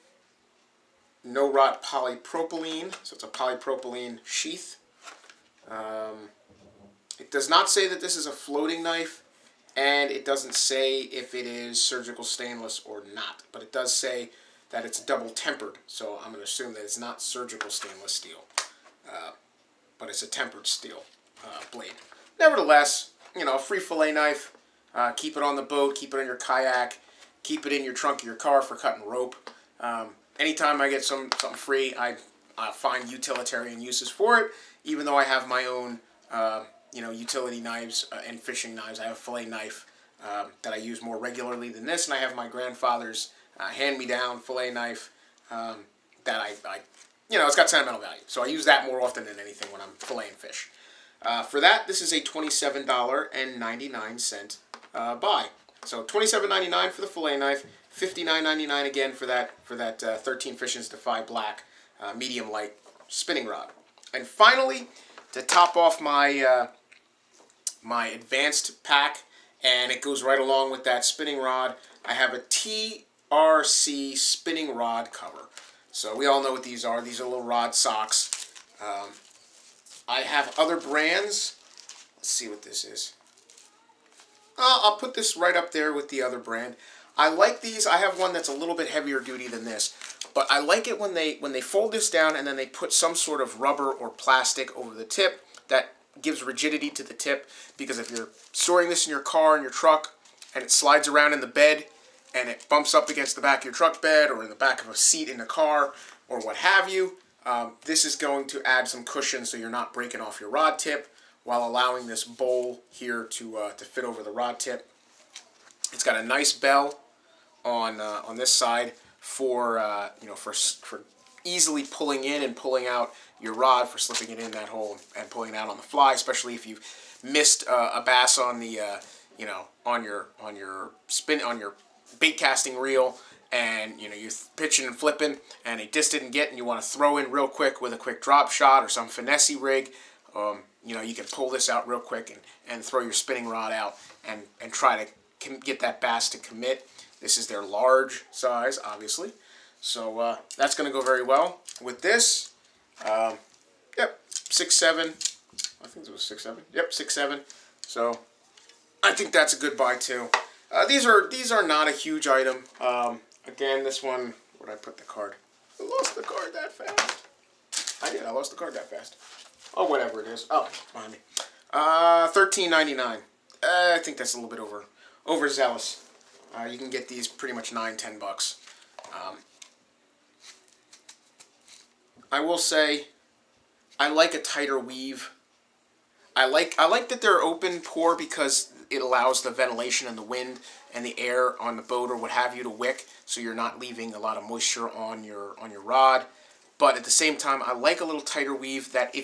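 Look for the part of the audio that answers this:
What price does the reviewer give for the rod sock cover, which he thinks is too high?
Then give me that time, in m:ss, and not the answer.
2:52.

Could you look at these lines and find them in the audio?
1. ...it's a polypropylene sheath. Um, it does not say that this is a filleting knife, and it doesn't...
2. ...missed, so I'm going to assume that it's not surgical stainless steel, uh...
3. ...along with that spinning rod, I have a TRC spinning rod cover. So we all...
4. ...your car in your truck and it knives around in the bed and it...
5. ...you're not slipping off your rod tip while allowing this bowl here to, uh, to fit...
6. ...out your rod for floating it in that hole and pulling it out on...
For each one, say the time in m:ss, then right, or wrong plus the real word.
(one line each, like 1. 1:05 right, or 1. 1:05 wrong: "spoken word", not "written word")
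1. 0:03 wrong: "floating", not "filleting"
2. 0:15 wrong: "tempered", not "missed"
3. 1:10 right
4. 1:39 wrong: "slides", not "knives"
5. 1:49 wrong: "breaking", not "slipping"
6. 2:02 wrong: "slipping", not "floating".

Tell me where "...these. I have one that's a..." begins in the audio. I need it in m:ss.
1:27.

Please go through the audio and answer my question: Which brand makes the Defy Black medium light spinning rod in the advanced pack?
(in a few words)
13 Fishing.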